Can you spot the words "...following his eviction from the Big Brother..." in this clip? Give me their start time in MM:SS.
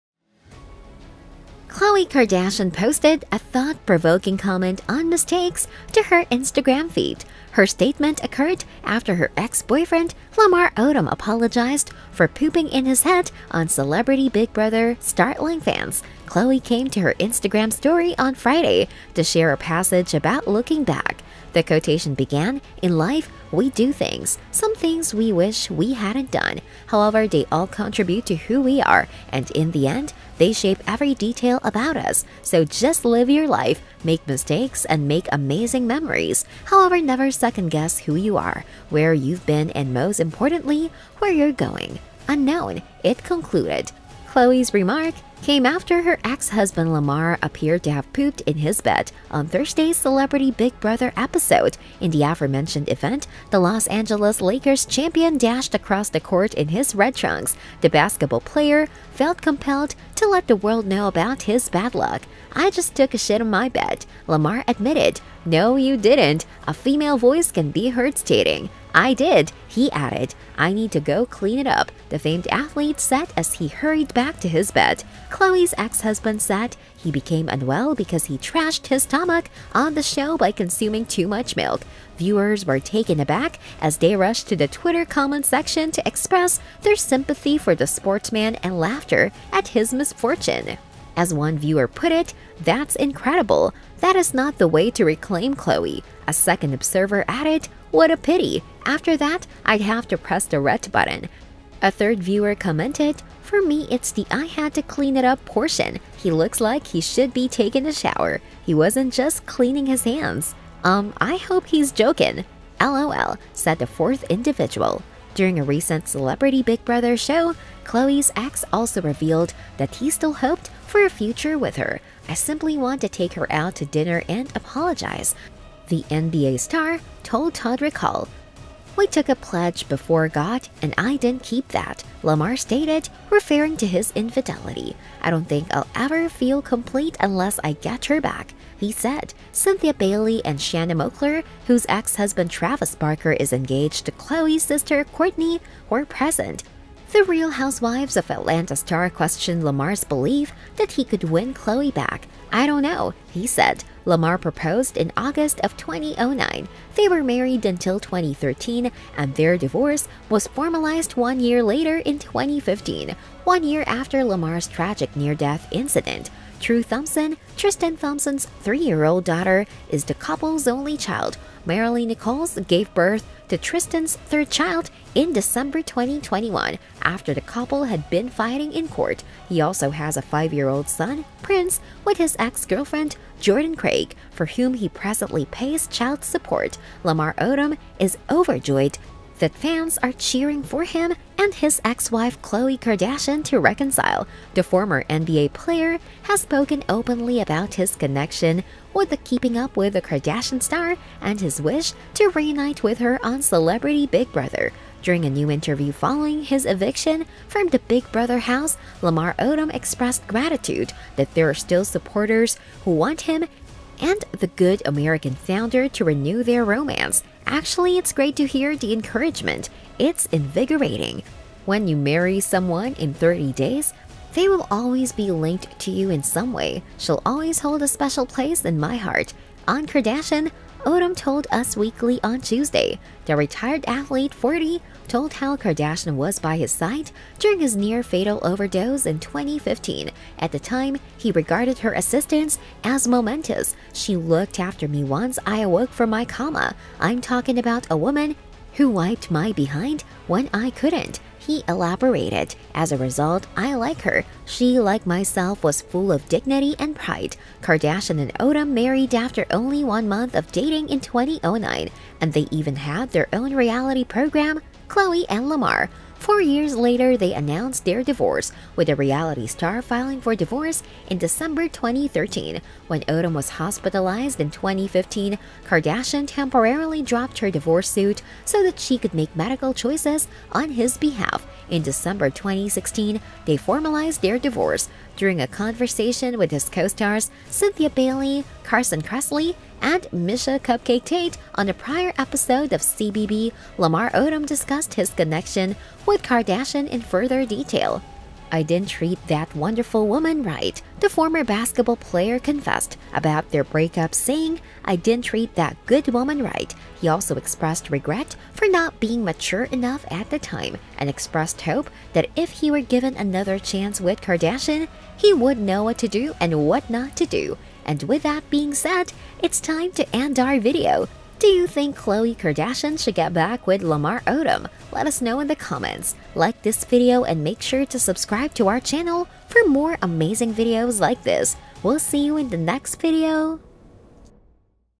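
03:25.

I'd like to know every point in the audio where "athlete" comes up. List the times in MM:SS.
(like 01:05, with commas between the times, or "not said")
01:12, 03:53.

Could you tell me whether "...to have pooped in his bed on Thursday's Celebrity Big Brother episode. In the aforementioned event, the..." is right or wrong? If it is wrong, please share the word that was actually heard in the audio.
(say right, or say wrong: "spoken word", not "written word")
right.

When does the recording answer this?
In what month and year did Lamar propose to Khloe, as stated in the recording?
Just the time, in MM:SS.
02:35.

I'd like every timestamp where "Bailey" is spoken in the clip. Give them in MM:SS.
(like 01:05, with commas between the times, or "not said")
02:19, 04:47.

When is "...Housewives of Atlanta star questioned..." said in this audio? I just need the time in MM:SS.
02:27.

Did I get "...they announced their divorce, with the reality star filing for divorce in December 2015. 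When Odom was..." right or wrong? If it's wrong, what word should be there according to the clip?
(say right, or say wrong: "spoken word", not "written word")
wrong: "2013", not "2015".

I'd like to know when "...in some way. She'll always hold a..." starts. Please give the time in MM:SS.
03:46.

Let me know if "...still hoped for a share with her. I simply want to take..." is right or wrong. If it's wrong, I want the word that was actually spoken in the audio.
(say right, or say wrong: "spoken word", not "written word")
wrong: "future", not "share".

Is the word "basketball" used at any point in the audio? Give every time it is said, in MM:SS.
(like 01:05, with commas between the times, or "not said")
00:57, 05:01.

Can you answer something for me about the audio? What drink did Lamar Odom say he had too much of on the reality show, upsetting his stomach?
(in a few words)
milk.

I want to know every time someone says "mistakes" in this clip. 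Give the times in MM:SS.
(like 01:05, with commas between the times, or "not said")
00:05, 00:34.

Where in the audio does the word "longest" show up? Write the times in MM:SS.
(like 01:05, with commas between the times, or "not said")
not said.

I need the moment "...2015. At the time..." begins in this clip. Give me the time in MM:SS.
03:59.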